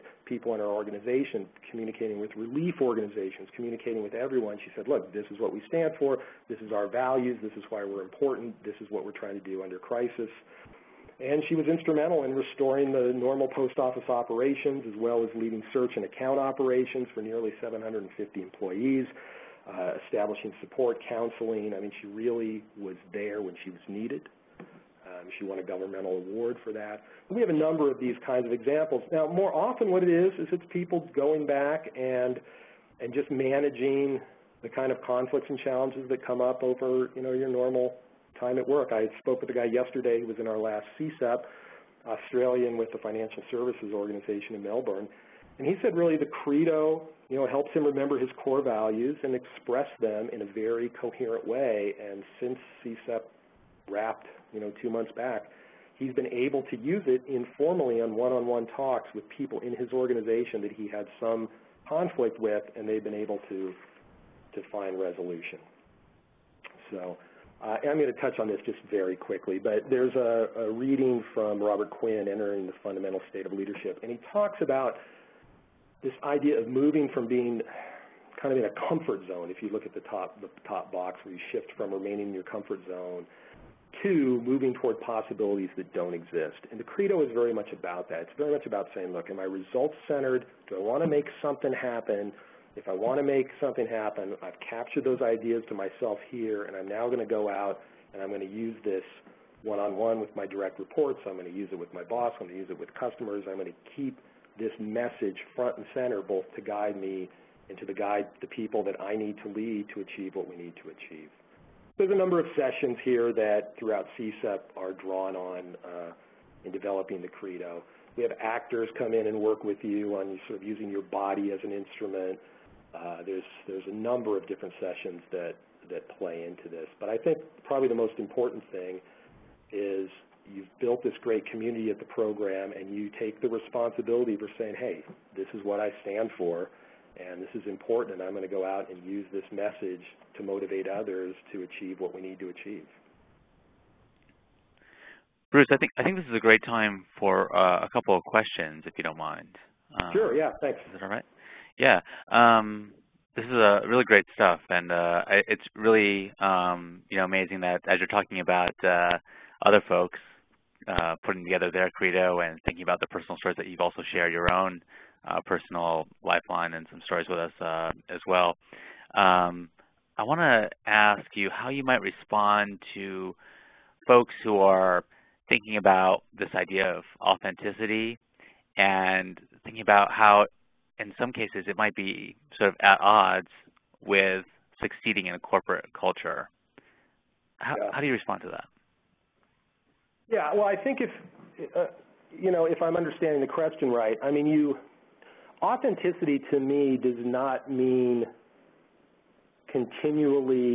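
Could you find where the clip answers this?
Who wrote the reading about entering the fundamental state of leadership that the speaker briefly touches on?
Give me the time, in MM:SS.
01:11.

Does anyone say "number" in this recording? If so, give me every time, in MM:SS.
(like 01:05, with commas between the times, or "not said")
00:27, 01:52, 02:03.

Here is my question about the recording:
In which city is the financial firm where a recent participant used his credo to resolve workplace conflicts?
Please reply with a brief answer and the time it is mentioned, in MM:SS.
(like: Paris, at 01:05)
Melbourne, at 00:44.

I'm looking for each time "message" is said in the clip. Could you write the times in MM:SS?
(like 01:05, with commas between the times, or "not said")
01:44, 02:19.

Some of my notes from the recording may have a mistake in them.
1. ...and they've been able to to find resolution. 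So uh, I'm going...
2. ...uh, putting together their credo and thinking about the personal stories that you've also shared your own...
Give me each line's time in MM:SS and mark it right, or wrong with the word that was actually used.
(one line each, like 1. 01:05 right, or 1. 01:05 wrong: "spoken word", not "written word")
1. 01:02 right
2. 02:40 right.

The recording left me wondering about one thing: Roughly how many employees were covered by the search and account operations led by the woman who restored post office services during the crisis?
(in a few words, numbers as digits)
750.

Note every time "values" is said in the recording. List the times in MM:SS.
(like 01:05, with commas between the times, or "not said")
00:06, 00:48.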